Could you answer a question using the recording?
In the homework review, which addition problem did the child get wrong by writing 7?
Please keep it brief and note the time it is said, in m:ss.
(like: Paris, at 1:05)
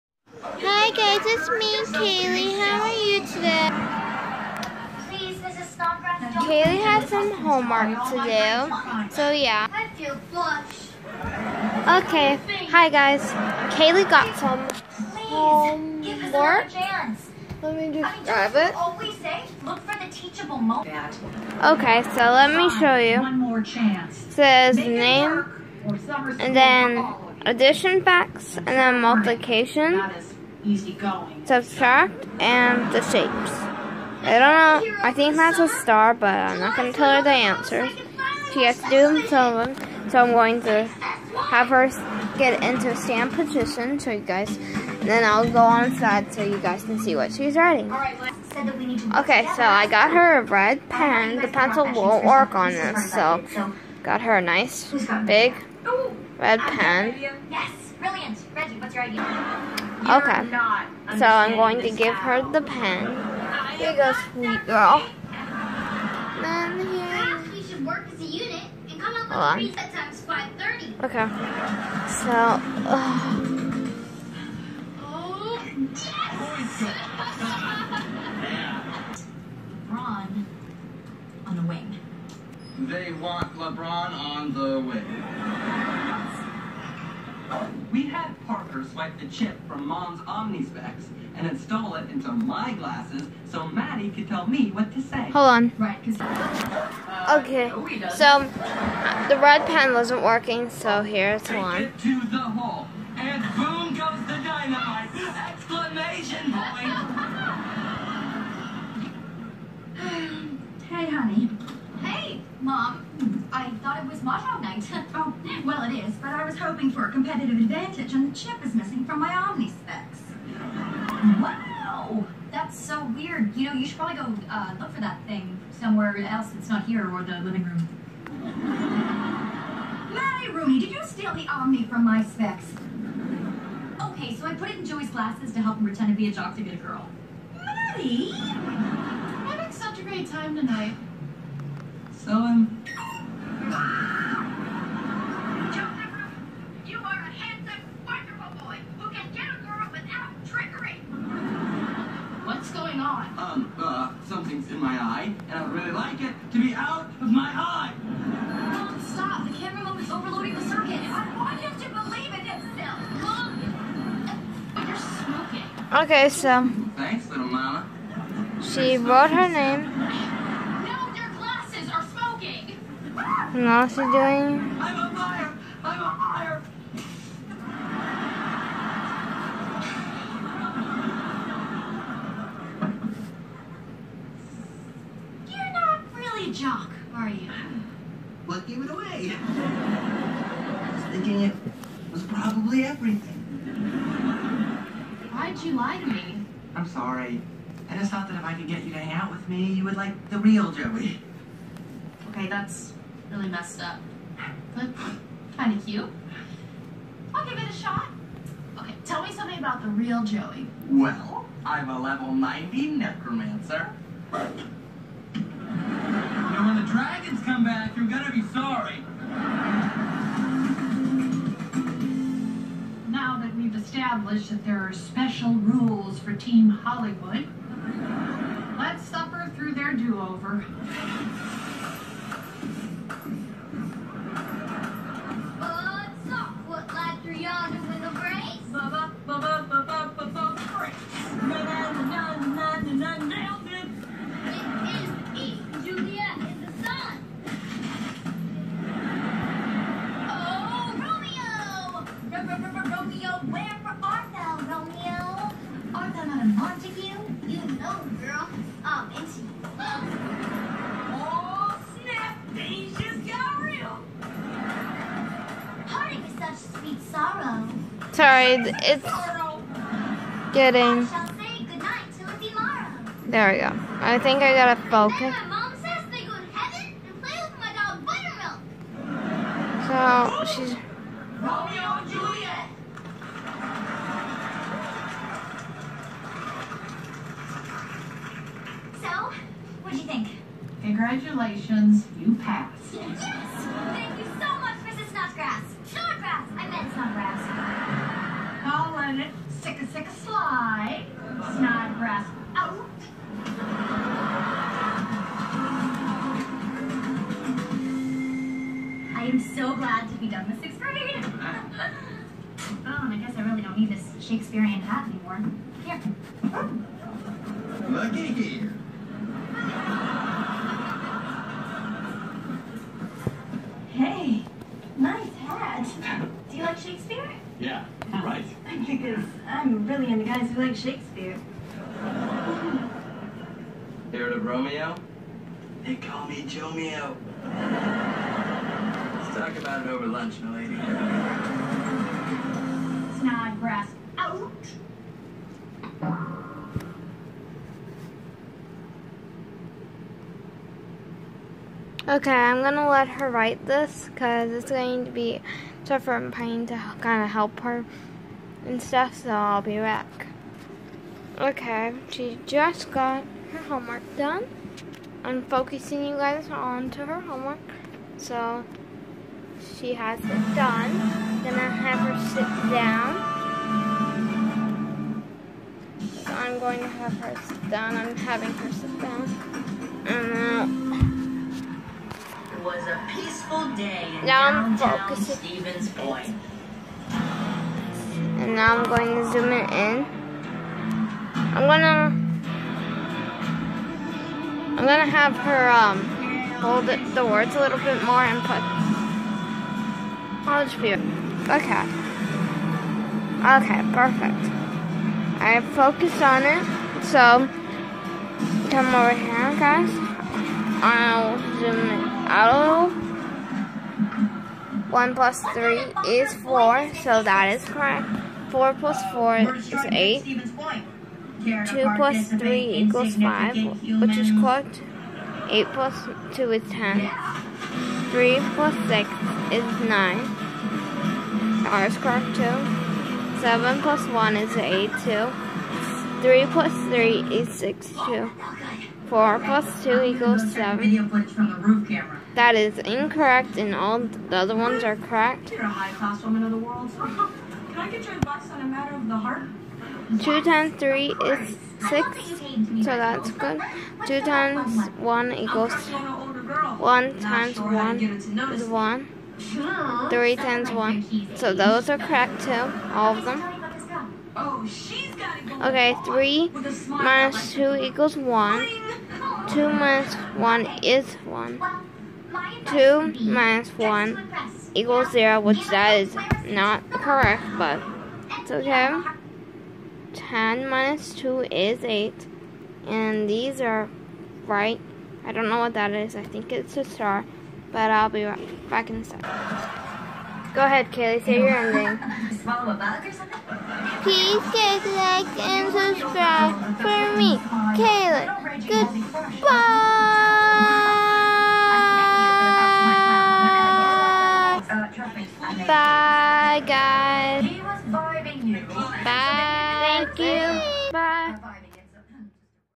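4 plus 2, at 7:19.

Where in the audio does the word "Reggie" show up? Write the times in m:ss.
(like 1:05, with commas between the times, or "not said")
0:58.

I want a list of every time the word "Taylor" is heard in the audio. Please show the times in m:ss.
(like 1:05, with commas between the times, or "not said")
not said.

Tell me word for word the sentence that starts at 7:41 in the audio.
So those are correct too, all of them.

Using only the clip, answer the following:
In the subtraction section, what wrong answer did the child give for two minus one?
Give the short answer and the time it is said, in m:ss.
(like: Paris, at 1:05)
0, at 7:55.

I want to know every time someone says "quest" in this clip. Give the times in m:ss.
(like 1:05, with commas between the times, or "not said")
not said.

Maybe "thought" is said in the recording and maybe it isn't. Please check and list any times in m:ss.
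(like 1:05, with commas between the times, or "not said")
1:53, 3:18.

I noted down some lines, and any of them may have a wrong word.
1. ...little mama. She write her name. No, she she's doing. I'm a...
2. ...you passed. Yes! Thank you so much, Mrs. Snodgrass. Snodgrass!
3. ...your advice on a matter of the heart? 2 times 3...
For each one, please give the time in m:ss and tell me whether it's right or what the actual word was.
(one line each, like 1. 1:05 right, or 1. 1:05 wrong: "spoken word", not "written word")
1. 2:47 wrong: "wrote", not "write"
2. 4:52 right
3. 7:28 right.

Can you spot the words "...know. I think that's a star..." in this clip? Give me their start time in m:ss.
0:34.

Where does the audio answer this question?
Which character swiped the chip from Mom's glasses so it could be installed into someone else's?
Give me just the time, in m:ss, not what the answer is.
1:28.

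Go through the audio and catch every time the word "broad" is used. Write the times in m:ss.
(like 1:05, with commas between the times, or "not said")
not said.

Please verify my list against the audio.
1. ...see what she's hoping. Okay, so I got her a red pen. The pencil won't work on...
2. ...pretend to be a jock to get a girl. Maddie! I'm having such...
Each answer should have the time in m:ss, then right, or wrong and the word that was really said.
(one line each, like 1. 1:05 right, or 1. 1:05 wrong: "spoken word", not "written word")
1. 0:46 wrong: "writing", not "hoping"
2. 2:15 right.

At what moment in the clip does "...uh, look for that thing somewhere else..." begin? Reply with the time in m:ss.
2:04.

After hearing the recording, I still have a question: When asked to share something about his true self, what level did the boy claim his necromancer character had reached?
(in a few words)
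90.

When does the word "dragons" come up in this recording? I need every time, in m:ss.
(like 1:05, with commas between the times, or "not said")
3:36.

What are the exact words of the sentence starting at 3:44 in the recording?
that there are special rules for Team Hollywood.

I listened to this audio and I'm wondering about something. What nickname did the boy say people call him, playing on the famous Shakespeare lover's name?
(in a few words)
Jomeo.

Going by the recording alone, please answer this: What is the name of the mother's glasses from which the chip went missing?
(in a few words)
Omnispecs.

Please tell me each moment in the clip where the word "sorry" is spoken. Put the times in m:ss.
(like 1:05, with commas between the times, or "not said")
3:16, 3:38.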